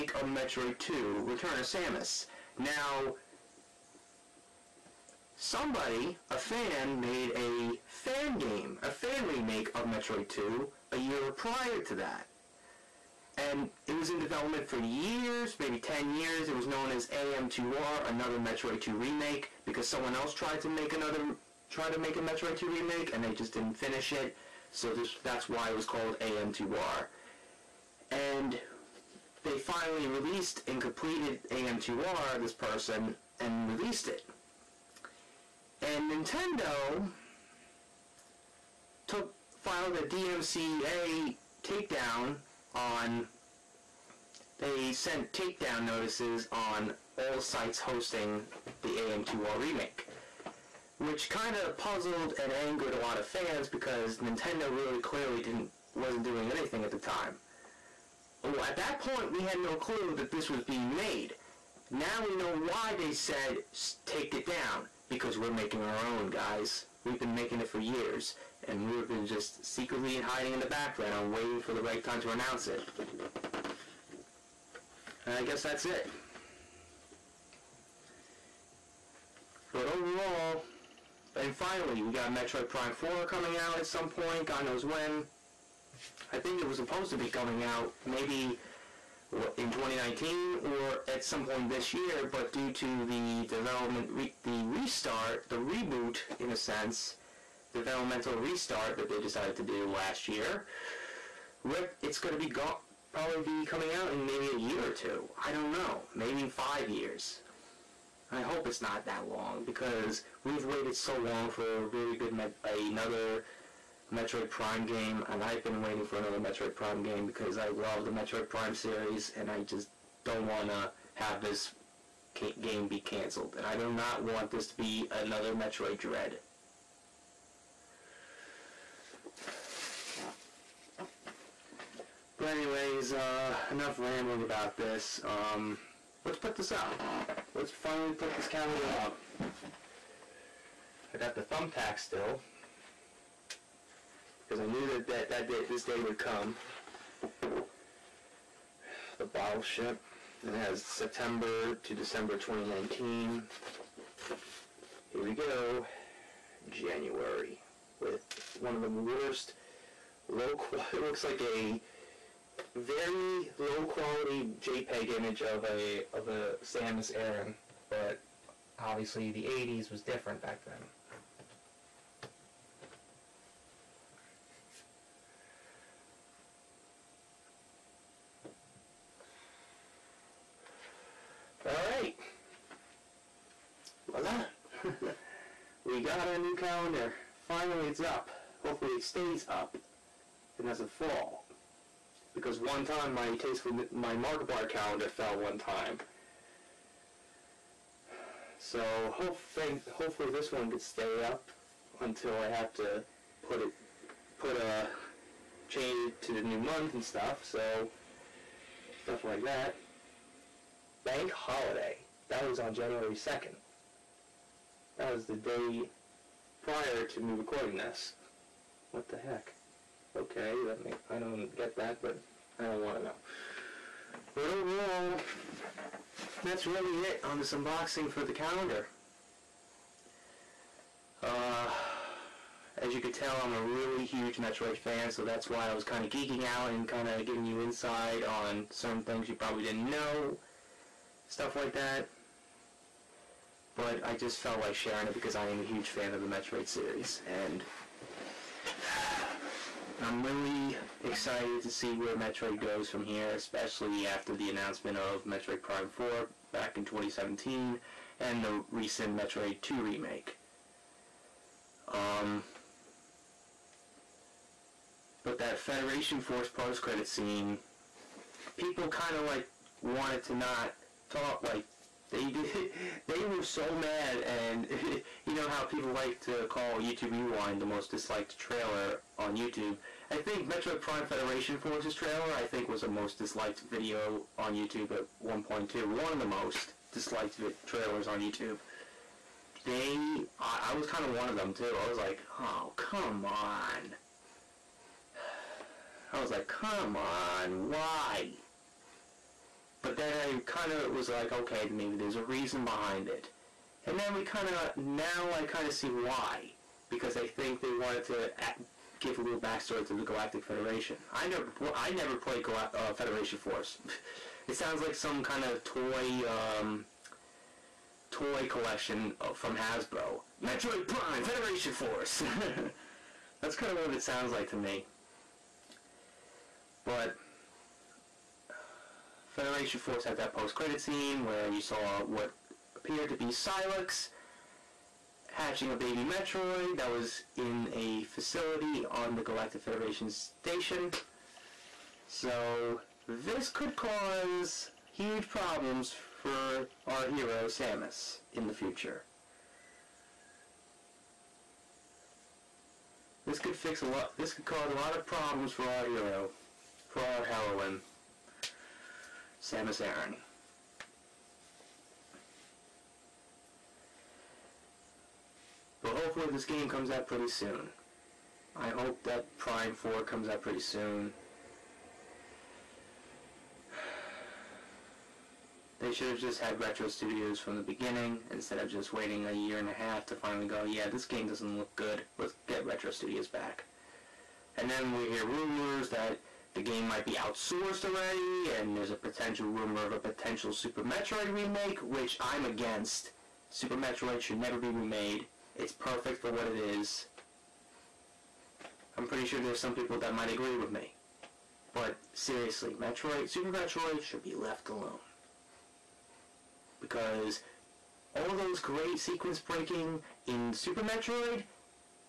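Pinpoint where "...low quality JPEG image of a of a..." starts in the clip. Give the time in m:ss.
2:43.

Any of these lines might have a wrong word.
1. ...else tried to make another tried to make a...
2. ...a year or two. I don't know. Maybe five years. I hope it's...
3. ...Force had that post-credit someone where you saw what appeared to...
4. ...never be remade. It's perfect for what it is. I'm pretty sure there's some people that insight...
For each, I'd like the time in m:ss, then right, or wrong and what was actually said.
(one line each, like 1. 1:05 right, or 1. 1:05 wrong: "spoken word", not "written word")
1. 0:20 right
2. 1:44 right
3. 5:29 wrong: "scene", not "someone"
4. 6:34 wrong: "might", not "insight".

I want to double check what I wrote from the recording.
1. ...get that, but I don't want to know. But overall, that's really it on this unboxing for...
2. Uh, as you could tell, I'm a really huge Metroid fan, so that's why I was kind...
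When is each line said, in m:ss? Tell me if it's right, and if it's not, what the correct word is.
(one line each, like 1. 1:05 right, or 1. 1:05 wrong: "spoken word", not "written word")
1. 3:41 right
2. 3:51 right.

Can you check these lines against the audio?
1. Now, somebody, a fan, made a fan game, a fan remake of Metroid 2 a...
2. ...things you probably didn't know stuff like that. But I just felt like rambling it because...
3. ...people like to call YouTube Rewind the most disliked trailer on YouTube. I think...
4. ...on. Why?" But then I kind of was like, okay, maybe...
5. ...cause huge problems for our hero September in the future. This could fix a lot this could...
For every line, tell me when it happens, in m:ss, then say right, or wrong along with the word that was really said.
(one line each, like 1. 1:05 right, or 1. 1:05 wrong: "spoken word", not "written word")
1. 0:02 right
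2. 3:59 wrong: "sharing", not "rambling"
3. 4:35 right
4. 4:56 right
5. 5:43 wrong: "Samus", not "September".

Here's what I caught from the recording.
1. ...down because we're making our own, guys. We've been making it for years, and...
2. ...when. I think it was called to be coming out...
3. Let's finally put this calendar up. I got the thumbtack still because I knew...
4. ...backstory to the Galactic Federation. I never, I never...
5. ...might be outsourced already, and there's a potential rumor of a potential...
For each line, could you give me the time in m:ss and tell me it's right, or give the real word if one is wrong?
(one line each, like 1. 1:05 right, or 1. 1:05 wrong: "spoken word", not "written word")
1. 1:04 right
2. 1:24 wrong: "supposed", not "called"
3. 2:17 right
4. 5:09 right
5. 6:26 right.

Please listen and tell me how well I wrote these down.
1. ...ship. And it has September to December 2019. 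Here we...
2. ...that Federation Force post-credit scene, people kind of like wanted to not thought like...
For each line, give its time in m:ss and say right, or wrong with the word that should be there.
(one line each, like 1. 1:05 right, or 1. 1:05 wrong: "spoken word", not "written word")
1. 2:29 right
2. 4:25 right.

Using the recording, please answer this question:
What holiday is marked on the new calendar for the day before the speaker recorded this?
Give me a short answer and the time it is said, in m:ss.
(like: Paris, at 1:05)
bank holiday, at 3:31.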